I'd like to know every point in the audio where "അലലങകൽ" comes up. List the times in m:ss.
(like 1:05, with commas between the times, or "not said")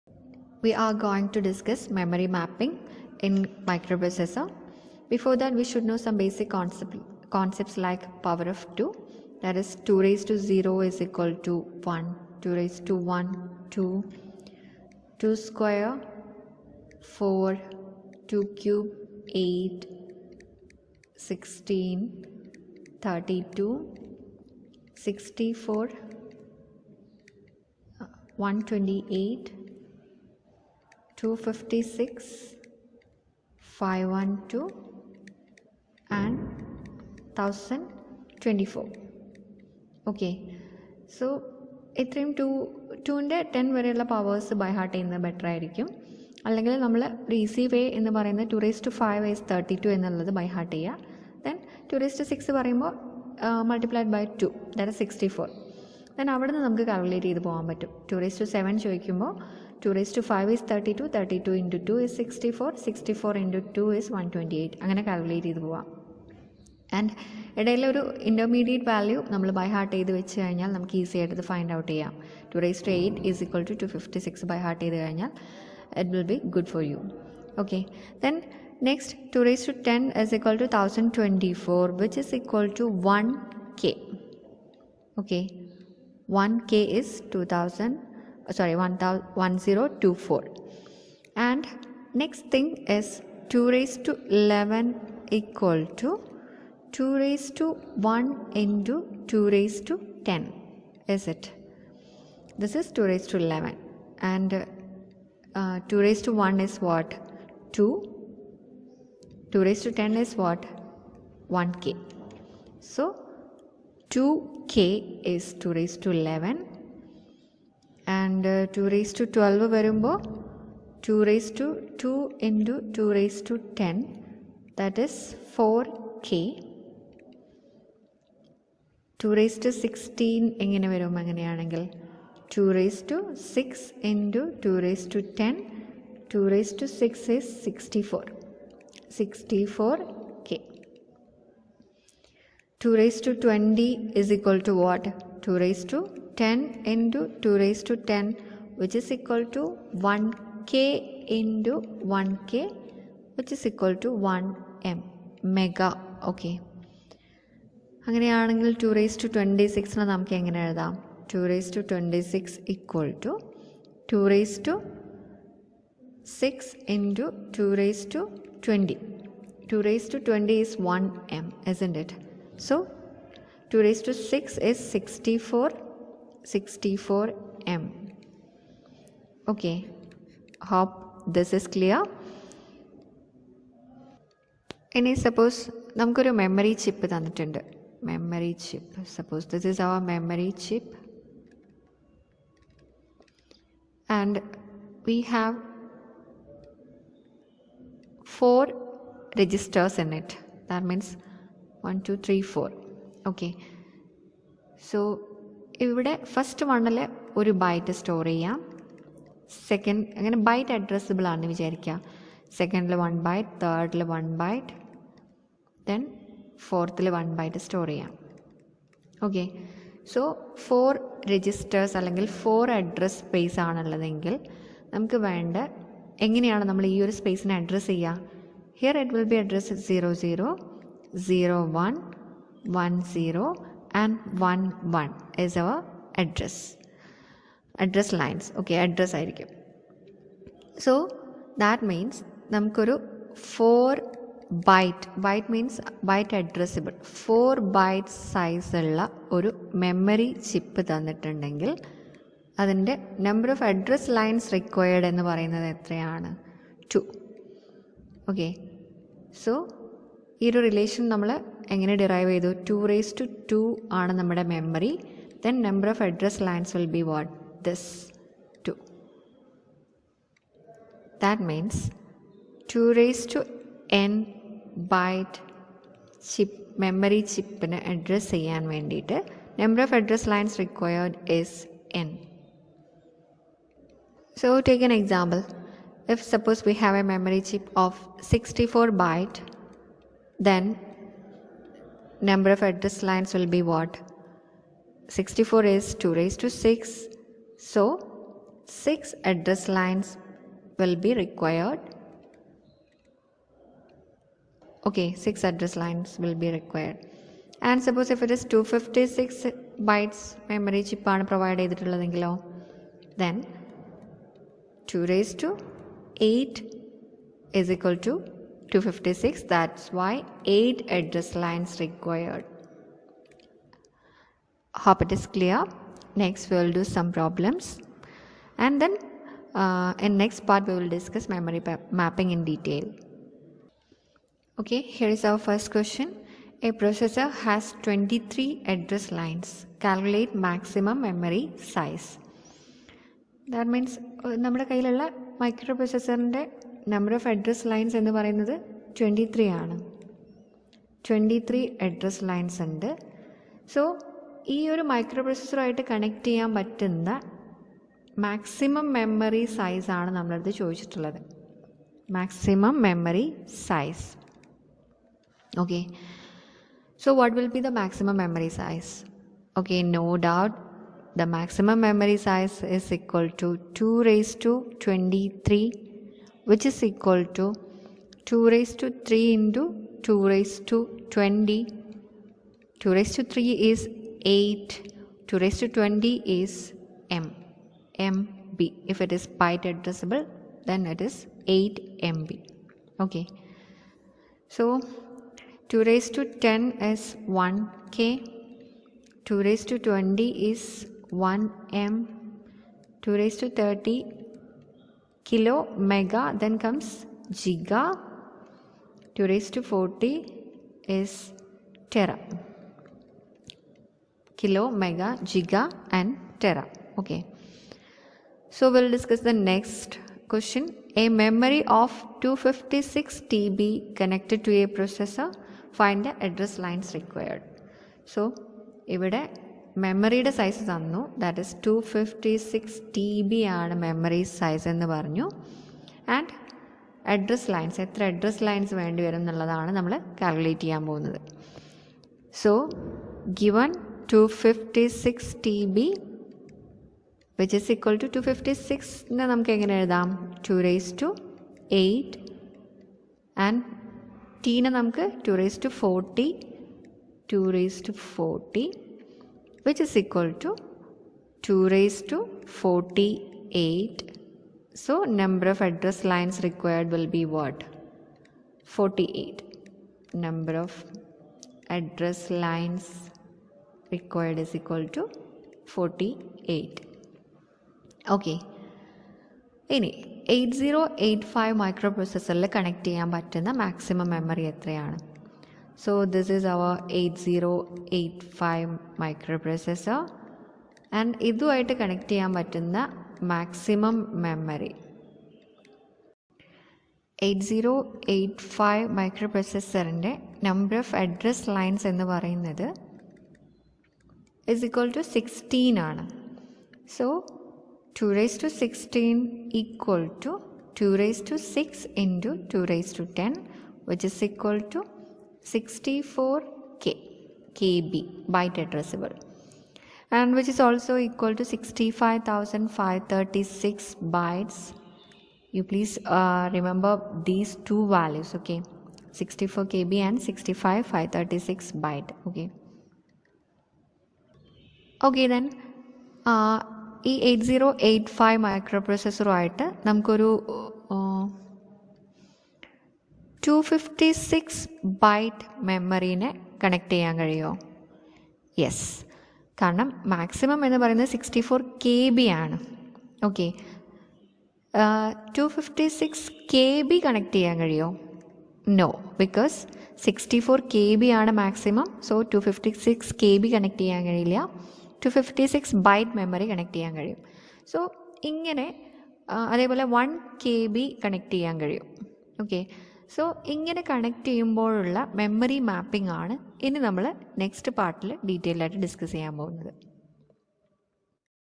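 0:46, 3:41.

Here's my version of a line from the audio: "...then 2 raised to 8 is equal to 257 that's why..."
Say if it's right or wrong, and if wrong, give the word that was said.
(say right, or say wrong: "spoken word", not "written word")
wrong: "256", not "257".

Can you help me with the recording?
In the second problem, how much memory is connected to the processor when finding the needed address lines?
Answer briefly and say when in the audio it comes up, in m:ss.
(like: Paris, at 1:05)
256 TB, at 7:02.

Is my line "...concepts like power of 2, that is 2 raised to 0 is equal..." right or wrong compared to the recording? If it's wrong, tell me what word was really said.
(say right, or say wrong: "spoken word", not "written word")
right.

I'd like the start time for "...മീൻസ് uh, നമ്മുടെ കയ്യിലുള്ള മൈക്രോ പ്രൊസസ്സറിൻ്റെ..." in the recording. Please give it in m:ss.
5:43.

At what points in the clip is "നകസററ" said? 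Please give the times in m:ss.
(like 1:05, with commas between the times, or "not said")
1:18, 9:37.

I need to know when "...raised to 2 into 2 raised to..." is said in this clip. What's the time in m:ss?
2:01.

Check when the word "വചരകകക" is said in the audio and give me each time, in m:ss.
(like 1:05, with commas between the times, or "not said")
3:31.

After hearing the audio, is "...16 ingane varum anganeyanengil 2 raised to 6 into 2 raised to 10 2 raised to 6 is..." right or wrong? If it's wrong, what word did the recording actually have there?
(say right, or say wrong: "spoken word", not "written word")
right.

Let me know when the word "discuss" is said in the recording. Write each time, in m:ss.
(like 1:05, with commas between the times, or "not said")
0:01, 5:30, 6:58.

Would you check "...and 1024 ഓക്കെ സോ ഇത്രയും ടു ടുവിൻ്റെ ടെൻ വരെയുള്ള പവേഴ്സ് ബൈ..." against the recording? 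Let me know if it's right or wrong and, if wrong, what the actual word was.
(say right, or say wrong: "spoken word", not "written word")
right.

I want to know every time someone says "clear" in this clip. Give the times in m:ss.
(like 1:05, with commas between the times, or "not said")
3:01, 5:25.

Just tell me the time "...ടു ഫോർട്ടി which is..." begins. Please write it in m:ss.
7:37.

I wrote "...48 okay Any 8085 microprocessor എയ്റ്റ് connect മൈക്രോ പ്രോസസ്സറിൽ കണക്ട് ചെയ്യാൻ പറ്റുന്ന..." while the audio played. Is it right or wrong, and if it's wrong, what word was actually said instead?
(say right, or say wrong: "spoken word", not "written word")
right.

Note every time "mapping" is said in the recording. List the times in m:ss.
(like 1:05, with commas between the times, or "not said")
0:02, 5:32.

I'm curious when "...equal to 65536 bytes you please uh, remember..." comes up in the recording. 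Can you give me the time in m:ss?
8:40.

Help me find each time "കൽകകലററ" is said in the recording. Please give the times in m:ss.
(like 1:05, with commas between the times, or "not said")
0:56, 1:05, 7:20.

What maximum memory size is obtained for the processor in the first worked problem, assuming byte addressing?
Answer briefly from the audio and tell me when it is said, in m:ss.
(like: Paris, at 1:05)
8 MB, at 6:31.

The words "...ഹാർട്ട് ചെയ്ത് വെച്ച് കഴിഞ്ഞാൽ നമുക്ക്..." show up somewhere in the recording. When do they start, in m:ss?
1:09.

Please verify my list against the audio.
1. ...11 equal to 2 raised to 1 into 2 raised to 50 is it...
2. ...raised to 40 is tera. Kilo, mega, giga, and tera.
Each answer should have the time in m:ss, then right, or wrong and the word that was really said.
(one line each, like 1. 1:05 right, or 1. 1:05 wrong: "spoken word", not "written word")
1. 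1:34 wrong: "10", not "50"
2. 6:49 right.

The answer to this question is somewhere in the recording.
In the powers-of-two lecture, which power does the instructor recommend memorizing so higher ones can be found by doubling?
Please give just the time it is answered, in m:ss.
0:48.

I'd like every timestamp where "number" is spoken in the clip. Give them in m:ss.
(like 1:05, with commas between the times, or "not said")
4:52, 7:45, 7:50.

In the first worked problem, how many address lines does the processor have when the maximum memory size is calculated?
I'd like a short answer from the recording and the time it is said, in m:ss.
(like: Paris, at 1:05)
23, at 5:36.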